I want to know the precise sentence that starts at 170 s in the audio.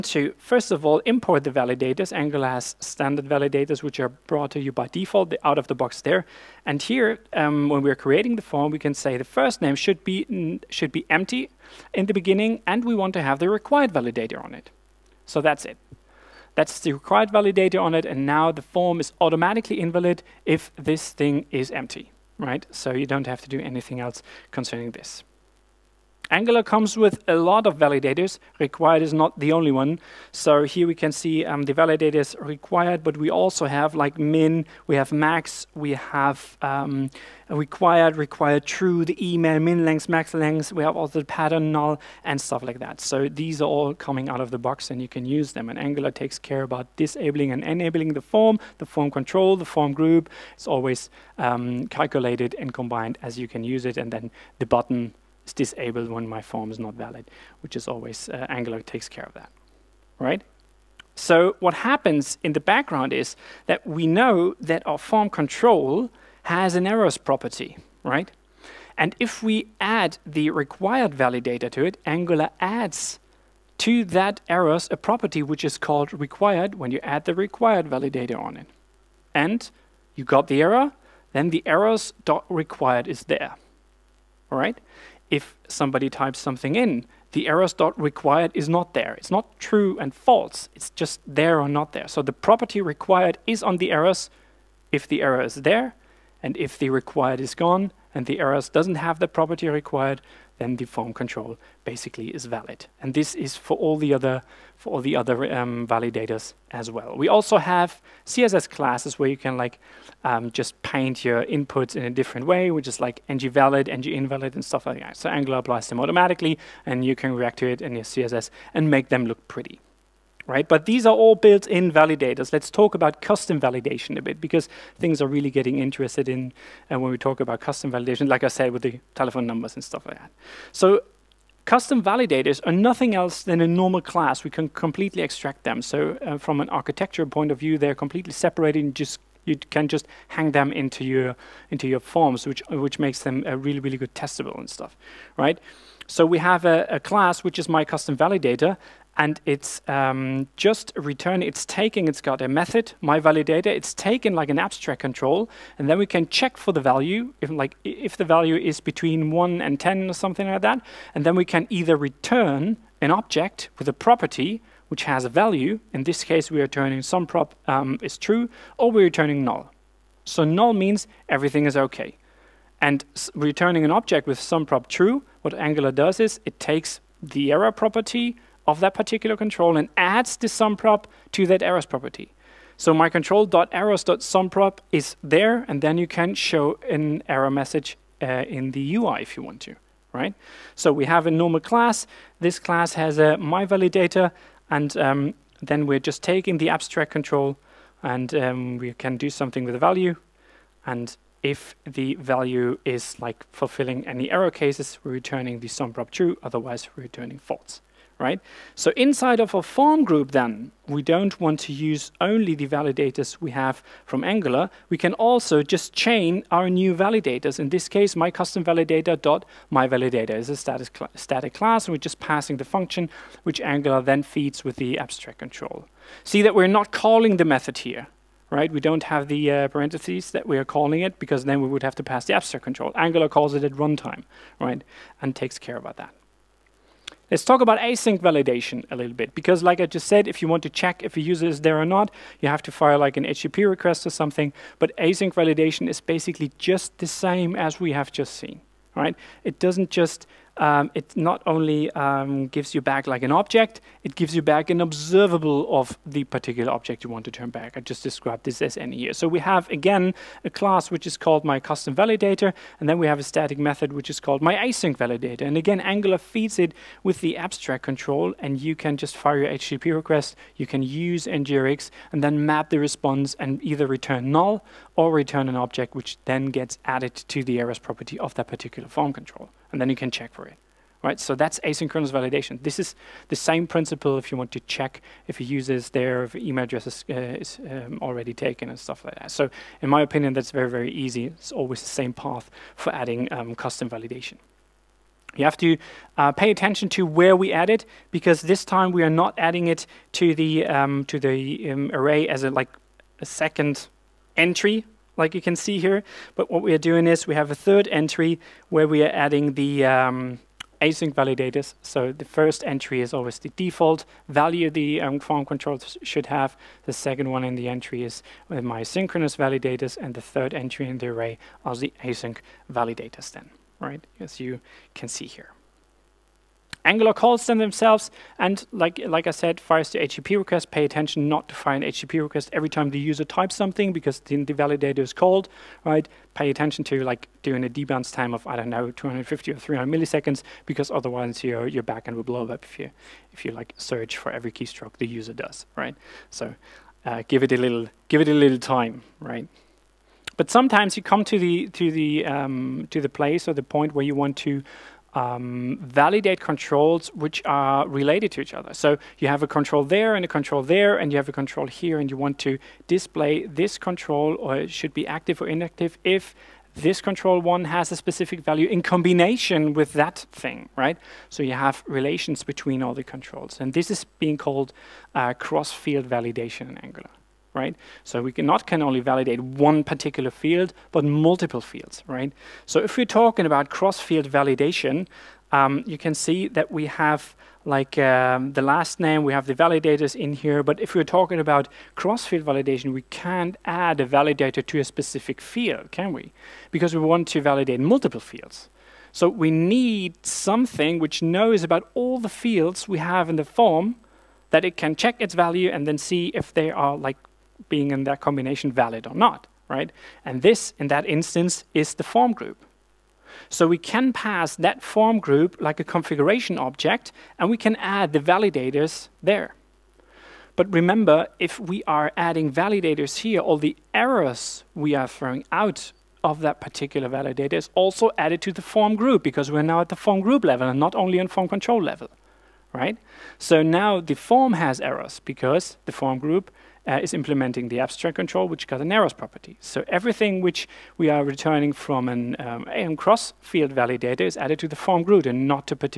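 So null means everything is okay.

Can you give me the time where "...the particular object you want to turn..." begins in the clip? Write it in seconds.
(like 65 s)
256 s.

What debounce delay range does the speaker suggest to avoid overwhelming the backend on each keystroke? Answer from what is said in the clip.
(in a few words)
250 or 300 milliseconds.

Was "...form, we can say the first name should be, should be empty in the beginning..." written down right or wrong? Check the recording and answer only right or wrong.
right.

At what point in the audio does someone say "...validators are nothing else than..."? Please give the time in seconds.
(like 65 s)
132 s.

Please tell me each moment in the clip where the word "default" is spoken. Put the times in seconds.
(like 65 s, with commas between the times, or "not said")
4 s, 313 s.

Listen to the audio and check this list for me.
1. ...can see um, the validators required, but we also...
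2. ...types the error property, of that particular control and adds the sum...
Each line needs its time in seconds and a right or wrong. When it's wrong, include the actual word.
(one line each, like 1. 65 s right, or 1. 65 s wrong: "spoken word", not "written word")
1. 30 s right
2. 176 s wrong: "takes", not "types".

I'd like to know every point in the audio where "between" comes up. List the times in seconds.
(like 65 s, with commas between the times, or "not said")
158 s, 372 s.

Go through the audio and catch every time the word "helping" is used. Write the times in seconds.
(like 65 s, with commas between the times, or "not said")
not said.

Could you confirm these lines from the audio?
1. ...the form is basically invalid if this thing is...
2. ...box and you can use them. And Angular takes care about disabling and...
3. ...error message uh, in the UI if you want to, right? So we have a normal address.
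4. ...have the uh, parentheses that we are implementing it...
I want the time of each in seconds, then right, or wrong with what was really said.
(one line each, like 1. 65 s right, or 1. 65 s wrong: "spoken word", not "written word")
1. 18 s wrong: "automatically", not "basically"
2. 44 s right
3. 187 s wrong: "class", not "address"
4. 229 s wrong: "calling", not "implementing".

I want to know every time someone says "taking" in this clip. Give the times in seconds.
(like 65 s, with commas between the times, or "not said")
151 s, 196 s.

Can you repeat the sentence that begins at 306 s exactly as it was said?
But what we are doing is we have a third entry where we are adding the um, async validators.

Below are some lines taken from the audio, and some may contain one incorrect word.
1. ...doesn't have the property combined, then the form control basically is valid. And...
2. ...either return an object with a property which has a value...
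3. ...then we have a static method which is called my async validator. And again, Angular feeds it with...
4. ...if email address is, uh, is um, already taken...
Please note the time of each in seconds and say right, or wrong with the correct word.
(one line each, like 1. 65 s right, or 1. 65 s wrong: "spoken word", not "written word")
1. 98 s wrong: "required", not "combined"
2. 161 s right
3. 262 s right
4. 286 s right.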